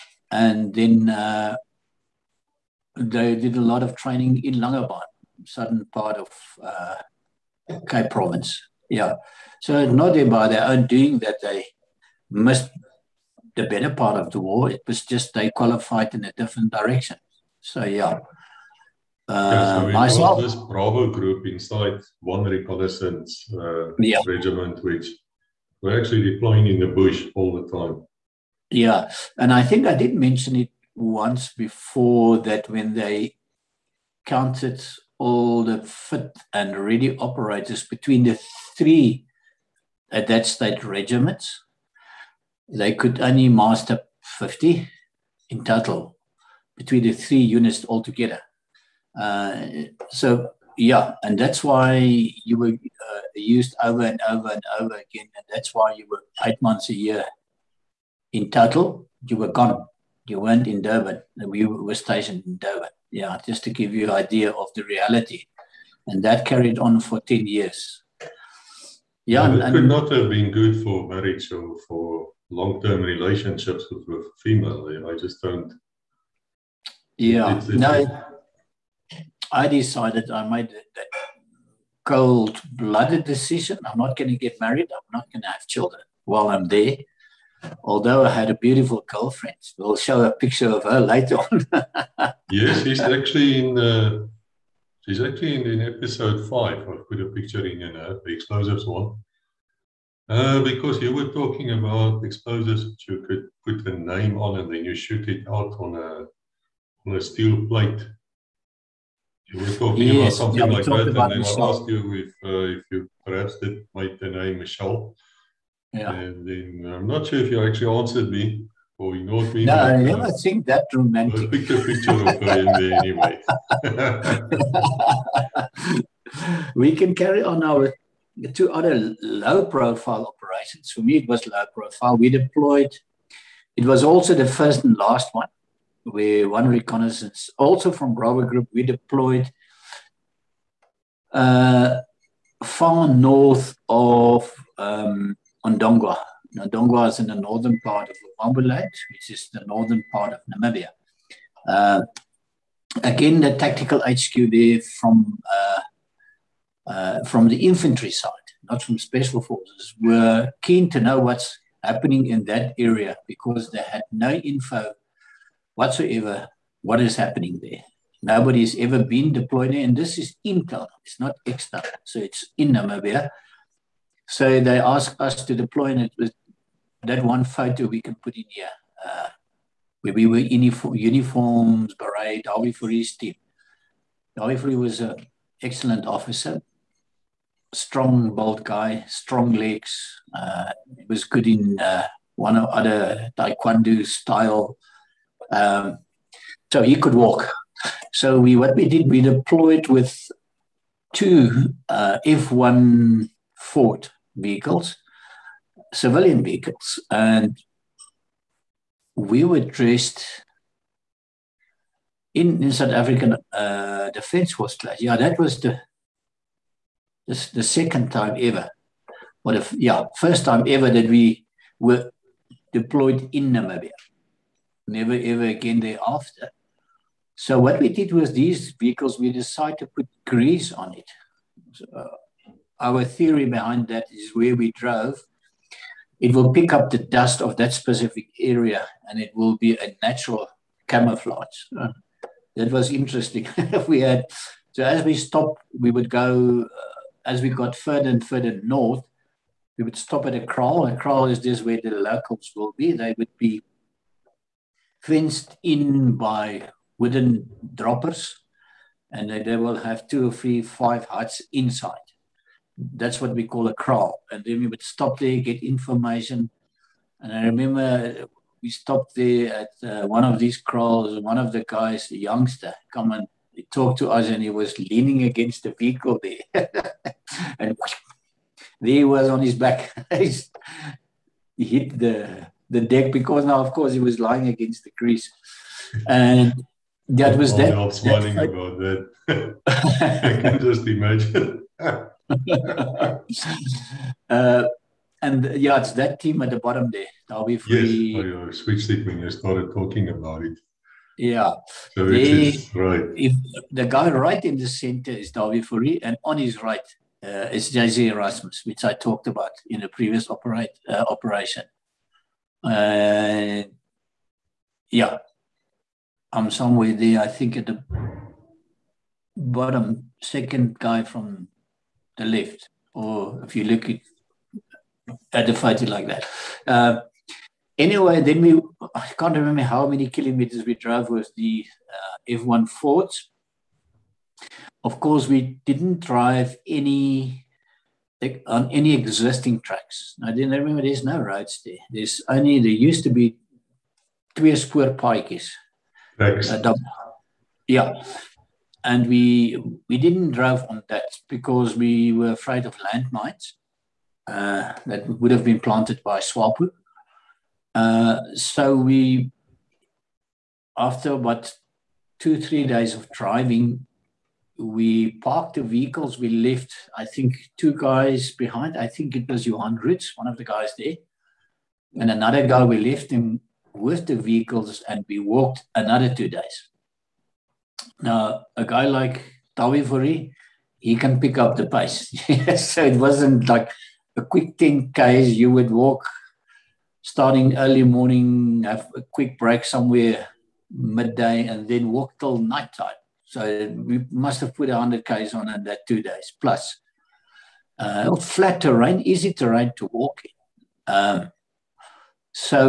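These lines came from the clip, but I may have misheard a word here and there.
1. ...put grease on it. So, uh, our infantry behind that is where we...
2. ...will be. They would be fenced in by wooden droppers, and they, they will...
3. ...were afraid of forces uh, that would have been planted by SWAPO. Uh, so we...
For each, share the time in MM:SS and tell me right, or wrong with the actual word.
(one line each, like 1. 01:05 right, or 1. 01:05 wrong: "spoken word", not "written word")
1. 03:49 wrong: "theory", not "infantry"
2. 04:12 right
3. 05:52 wrong: "landmines", not "forces".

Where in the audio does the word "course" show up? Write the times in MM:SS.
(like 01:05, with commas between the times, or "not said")
04:43, 05:34.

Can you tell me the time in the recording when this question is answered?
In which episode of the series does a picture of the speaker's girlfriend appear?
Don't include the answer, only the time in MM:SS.
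01:35.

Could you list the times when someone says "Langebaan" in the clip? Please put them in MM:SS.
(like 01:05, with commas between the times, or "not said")
00:04.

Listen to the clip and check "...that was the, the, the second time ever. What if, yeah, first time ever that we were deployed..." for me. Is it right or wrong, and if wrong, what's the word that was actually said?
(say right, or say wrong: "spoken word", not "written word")
right.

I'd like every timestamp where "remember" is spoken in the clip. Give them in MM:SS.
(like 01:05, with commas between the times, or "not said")
04:27, 05:29, 05:40.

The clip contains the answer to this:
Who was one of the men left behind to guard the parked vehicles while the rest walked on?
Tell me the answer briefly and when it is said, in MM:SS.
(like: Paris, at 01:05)
Johan Ritz, at 06:09.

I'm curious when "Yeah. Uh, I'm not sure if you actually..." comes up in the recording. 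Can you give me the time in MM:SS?
01:55.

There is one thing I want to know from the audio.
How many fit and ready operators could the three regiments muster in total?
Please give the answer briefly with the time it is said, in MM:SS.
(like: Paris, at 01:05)
50, at 00:44.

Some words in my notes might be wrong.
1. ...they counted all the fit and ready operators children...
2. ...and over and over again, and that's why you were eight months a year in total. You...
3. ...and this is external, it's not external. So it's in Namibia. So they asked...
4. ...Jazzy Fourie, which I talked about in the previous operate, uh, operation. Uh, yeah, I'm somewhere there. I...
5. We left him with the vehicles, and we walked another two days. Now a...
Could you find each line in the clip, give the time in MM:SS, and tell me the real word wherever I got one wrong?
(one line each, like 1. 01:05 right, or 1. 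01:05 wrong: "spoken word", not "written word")
1. 00:32 wrong: "between", not "children"
2. 00:54 right
3. 02:49 wrong: "internal", not "external"
4. 05:07 wrong: "Erasmus", not "Fourie"
5. 06:12 right.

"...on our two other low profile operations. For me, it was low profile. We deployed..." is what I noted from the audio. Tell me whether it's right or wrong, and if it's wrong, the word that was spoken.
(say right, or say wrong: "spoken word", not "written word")
right.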